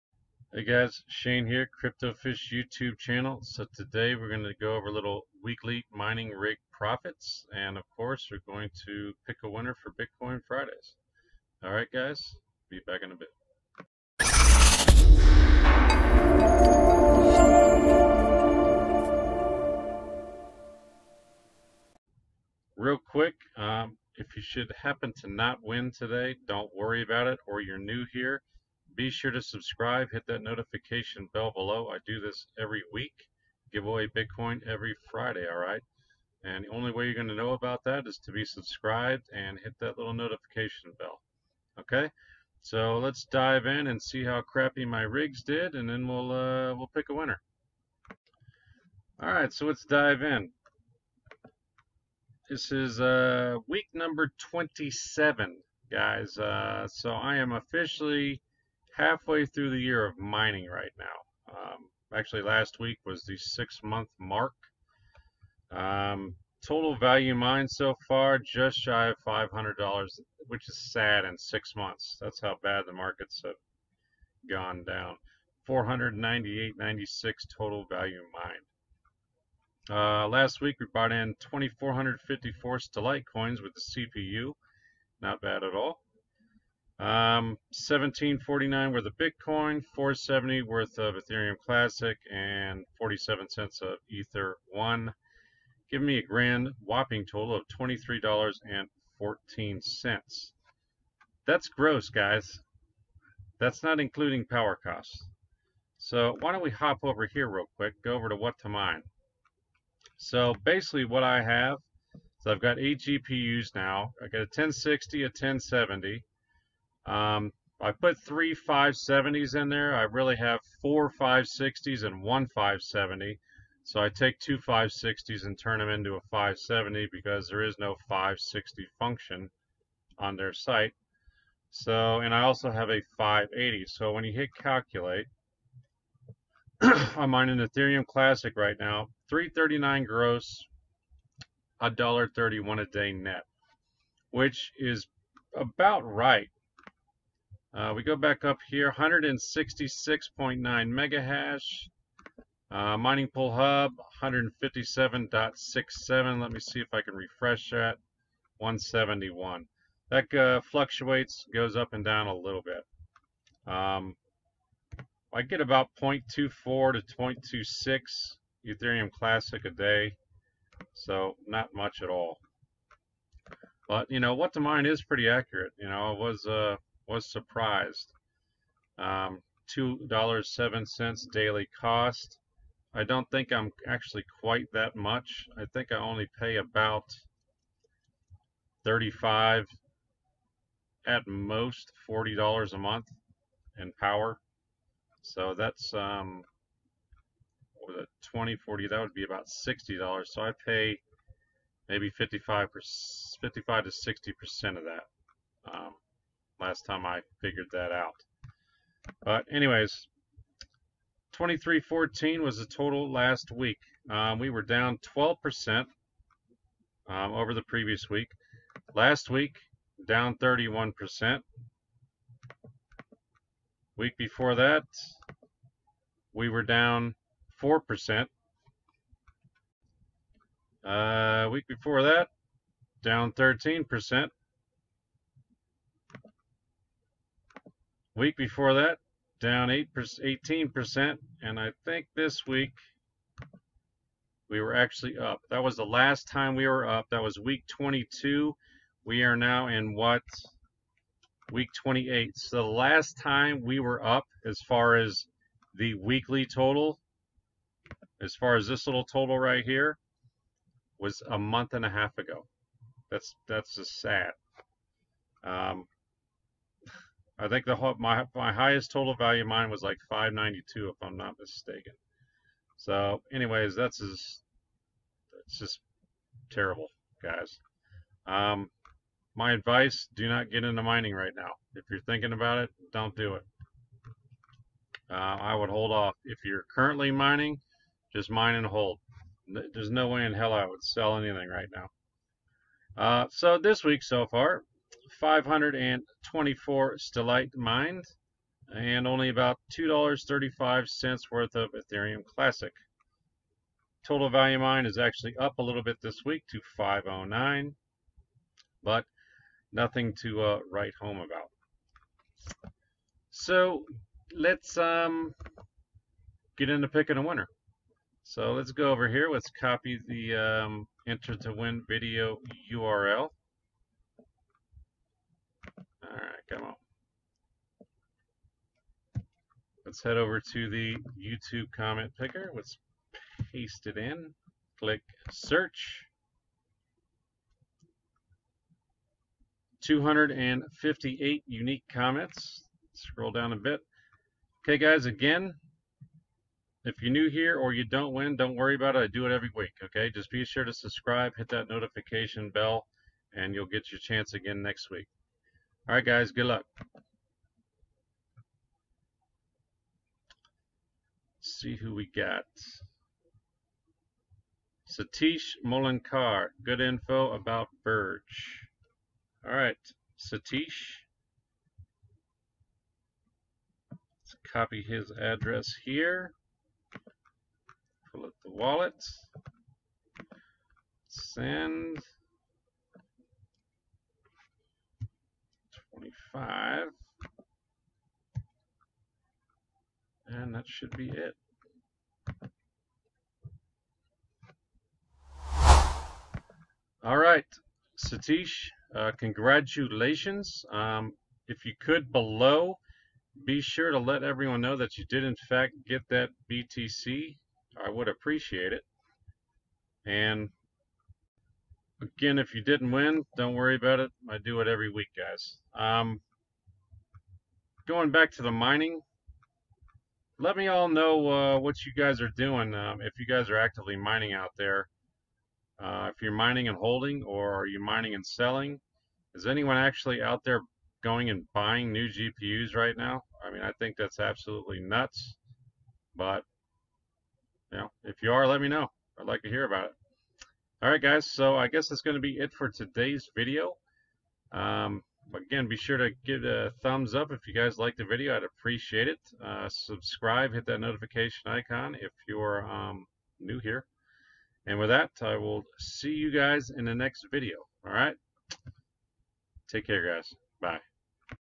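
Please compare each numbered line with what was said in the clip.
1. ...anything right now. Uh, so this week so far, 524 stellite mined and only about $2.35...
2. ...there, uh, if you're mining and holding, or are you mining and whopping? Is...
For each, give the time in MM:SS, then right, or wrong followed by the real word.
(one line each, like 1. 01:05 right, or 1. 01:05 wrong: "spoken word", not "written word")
1. 04:51 right
2. 07:04 wrong: "selling", not "whopping".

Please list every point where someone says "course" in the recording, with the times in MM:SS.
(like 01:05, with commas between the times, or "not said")
00:07.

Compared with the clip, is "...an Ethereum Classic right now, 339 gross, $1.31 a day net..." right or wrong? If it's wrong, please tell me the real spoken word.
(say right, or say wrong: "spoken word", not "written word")
right.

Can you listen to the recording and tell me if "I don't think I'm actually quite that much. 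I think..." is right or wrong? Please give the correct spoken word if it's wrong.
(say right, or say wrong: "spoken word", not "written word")
right.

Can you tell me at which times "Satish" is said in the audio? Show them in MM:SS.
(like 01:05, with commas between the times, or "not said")
06:04, 06:10, 06:37.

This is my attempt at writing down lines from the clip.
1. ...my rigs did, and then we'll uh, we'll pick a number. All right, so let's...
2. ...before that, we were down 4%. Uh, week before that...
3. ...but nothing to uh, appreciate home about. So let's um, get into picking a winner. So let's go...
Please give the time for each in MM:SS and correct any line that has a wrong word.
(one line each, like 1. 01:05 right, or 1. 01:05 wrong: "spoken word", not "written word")
1. 00:44 wrong: "winner", not "number"
2. 03:44 right
3. 05:08 wrong: "write", not "appreciate".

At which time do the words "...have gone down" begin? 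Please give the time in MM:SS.
01:13.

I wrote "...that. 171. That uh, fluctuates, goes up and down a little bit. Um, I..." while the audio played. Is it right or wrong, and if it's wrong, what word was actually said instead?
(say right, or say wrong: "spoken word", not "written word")
right.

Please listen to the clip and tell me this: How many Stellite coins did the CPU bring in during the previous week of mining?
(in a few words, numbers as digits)
2,454.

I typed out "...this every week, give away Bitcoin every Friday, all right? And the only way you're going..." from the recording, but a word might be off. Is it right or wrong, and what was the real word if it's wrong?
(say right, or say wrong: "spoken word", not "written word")
right.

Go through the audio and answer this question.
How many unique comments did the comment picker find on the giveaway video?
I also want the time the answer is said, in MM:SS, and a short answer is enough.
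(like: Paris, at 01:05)
258, at 05:39.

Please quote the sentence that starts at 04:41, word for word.
If you're thinking about it, don't do it.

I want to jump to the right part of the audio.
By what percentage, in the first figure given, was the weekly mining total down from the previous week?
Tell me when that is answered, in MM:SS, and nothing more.
03:35.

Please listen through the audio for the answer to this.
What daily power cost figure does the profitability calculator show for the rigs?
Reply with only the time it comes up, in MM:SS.
02:59.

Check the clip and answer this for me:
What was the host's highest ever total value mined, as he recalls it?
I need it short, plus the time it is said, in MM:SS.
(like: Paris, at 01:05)
592, at 04:30.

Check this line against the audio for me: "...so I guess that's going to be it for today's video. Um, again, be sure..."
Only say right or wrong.
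right.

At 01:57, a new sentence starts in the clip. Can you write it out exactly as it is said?
Um, I put three 570s in there.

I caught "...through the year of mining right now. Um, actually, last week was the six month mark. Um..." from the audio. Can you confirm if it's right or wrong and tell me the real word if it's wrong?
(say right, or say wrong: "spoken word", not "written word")
right.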